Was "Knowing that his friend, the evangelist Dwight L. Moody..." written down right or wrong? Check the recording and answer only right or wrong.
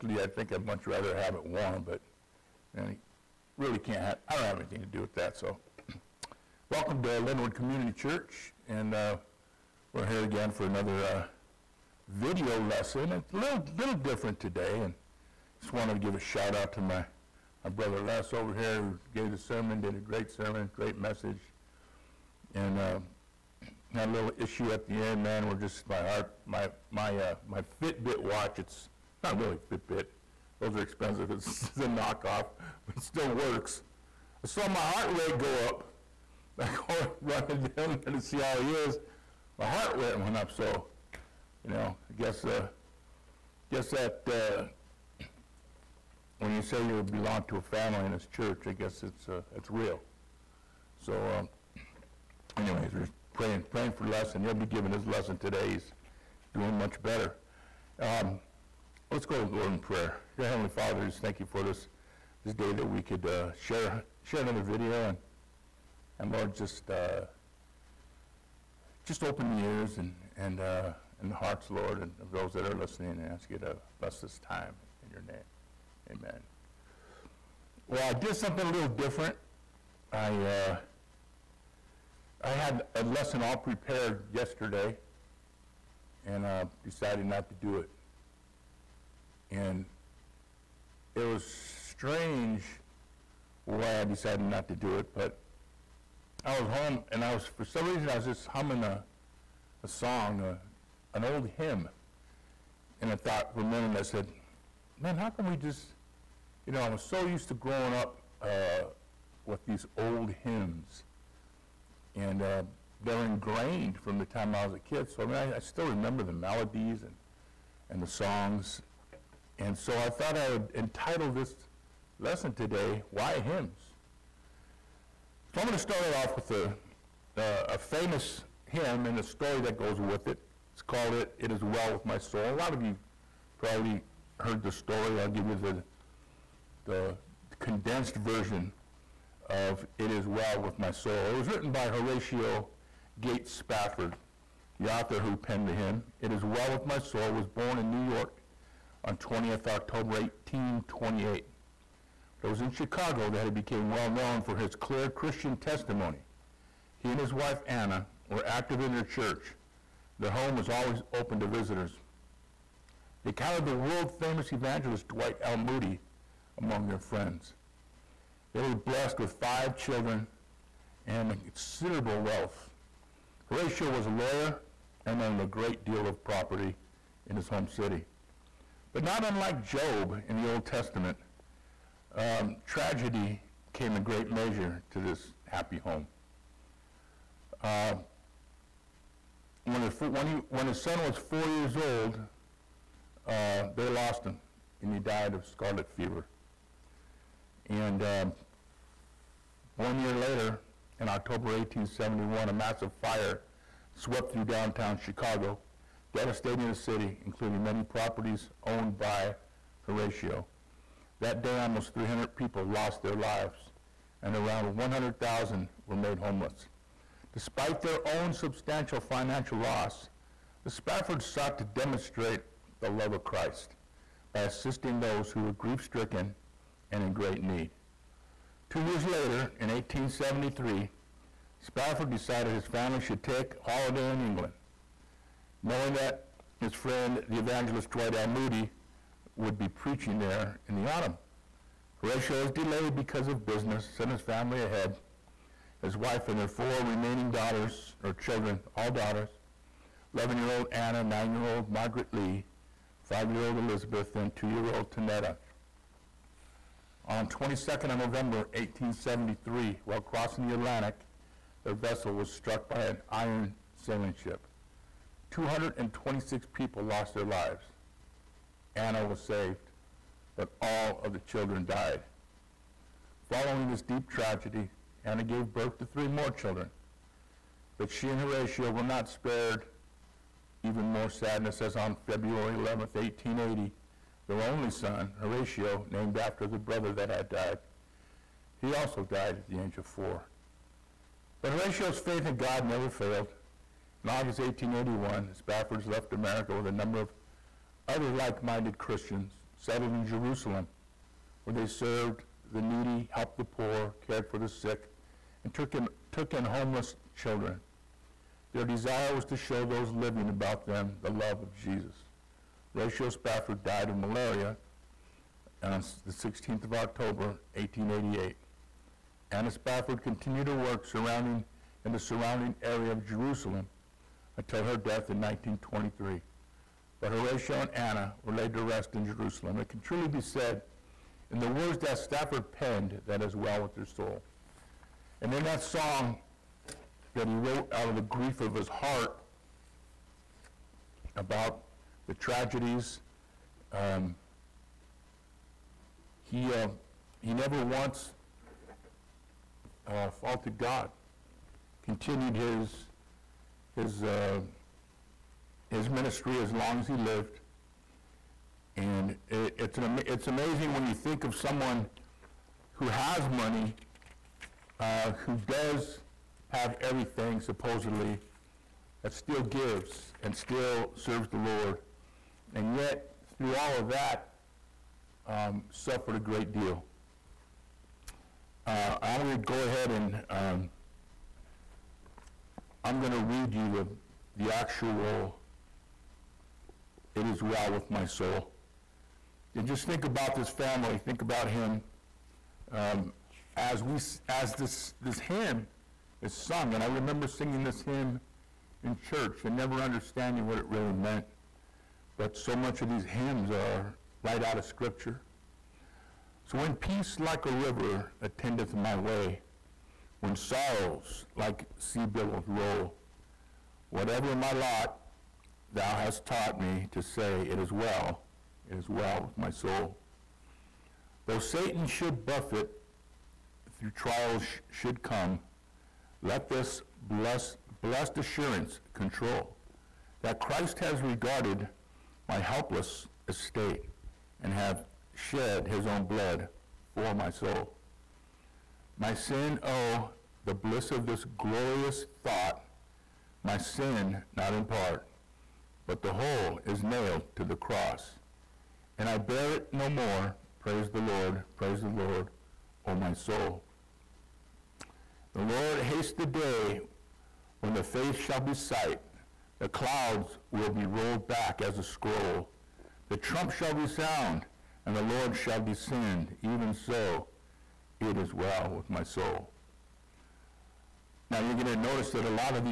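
right.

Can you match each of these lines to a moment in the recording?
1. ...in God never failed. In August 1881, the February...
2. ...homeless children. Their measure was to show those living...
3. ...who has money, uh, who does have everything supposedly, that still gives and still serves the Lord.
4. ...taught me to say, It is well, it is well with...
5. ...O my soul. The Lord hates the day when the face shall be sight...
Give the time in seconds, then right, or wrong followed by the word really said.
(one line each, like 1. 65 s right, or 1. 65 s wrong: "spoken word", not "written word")
1. 292 s wrong: "Spaffords", not "February"
2. 306 s wrong: "desire", not "measure"
3. 362 s right
4. 416 s right
5. 452 s right.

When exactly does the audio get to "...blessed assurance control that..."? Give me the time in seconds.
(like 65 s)
427 s.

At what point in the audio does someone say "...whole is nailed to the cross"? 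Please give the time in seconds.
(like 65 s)
446 s.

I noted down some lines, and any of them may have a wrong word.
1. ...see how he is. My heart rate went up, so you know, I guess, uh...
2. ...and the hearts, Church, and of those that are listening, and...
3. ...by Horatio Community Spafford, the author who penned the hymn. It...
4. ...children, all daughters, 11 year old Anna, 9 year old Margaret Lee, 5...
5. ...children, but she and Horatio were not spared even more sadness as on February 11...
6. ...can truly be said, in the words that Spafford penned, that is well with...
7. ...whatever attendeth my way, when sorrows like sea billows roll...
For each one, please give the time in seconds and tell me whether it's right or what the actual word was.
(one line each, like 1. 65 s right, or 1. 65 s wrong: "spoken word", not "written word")
1. 38 s right
2. 71 s wrong: "Lord", not "Church"
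3. 141 s wrong: "Gates", not "Community"
4. 248 s right
5. 276 s right
6. 329 s right
7. 407 s wrong: "river", not "whatever".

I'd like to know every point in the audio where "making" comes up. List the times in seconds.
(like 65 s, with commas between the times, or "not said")
not said.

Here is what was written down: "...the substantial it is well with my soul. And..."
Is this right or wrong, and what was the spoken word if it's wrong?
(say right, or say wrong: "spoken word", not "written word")
wrong: "actual", not "substantial".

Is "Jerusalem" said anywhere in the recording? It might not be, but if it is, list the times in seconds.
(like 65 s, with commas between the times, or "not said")
300 s, 323 s, 329 s.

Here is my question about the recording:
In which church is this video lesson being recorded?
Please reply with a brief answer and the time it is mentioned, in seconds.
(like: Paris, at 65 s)
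Linwood Community Church, at 7 s.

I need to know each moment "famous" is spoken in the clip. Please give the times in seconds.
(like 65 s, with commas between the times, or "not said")
127 s, 164 s.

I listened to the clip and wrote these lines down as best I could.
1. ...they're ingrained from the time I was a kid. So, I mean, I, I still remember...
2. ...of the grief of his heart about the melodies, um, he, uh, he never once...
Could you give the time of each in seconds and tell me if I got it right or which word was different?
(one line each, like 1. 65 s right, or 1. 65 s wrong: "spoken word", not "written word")
1. 113 s right
2. 337 s wrong: "tragedies", not "melodies".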